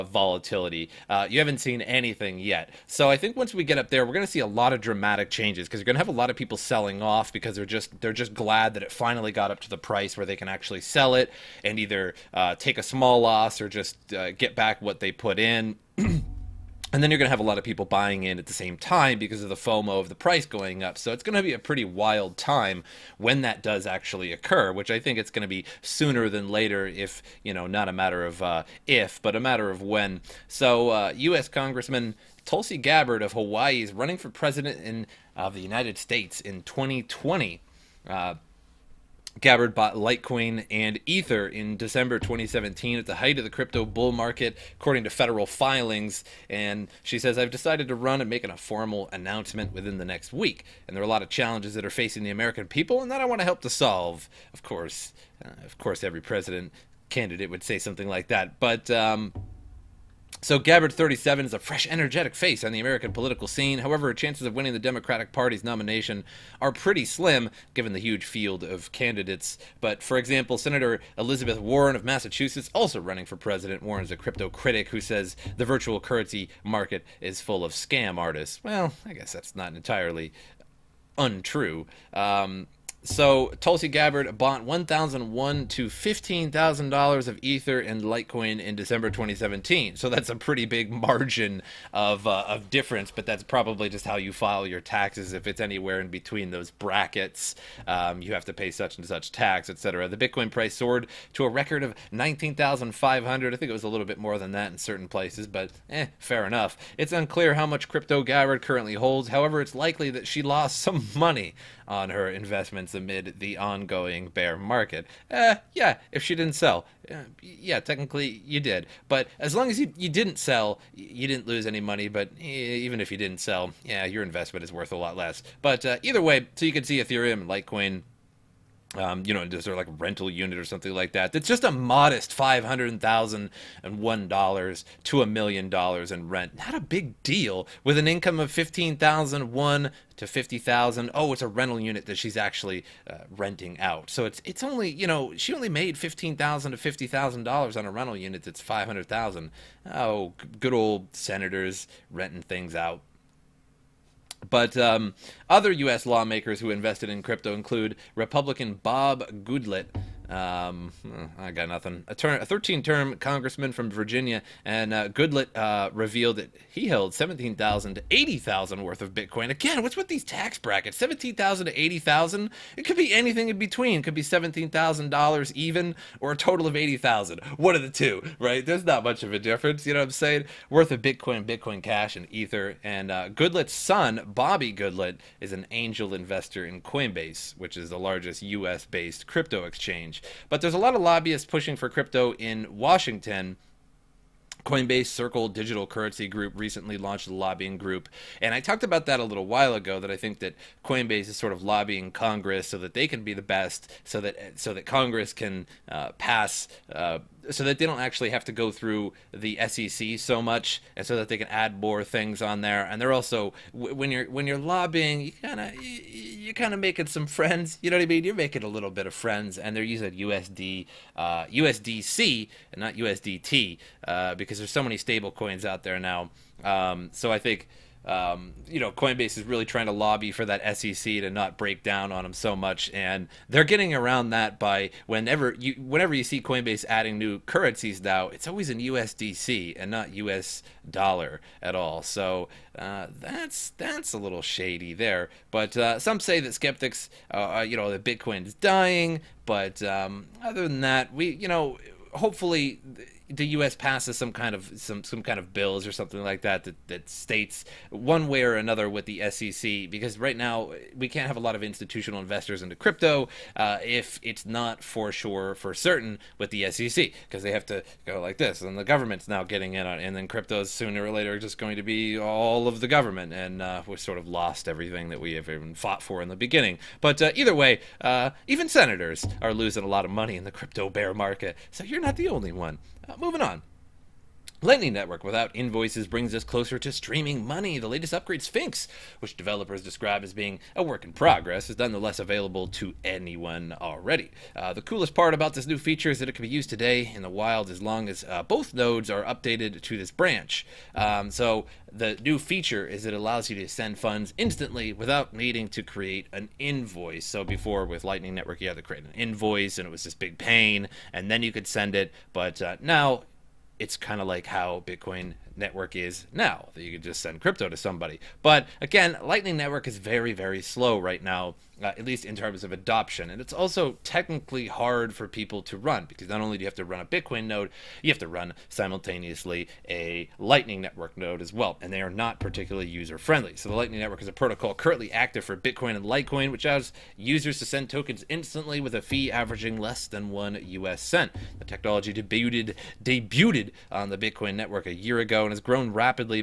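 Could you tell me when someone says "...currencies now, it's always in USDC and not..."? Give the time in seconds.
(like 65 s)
237 s.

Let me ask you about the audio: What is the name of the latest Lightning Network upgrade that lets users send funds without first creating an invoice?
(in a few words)
Sphinx.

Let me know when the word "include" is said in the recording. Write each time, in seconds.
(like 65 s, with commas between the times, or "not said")
157 s.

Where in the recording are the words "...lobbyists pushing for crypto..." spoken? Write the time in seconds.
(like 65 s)
191 s.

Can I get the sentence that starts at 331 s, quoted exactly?
And they are not particularly user friendly.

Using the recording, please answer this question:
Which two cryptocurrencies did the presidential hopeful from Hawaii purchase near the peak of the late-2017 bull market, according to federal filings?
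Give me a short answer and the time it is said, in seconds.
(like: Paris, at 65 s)
Litecoin and Ether, at 39 s.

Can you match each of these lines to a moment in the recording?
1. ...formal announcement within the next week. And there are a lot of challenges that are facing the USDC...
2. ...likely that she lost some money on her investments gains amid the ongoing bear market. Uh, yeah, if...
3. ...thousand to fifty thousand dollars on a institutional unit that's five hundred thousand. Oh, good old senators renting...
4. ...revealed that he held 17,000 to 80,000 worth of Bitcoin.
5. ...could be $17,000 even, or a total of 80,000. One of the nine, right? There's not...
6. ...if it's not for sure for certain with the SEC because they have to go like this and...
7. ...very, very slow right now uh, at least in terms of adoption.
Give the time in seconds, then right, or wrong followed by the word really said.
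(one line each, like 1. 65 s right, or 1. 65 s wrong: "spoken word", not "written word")
1. 48 s wrong: "American", not "USDC"
2. 109 s right
3. 146 s wrong: "rental", not "institutional"
4. 165 s right
5. 174 s wrong: "two", not "nine"
6. 263 s right
7. 319 s right.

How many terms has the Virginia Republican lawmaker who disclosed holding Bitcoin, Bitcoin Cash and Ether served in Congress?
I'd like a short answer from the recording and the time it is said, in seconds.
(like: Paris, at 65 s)
13, at 162 s.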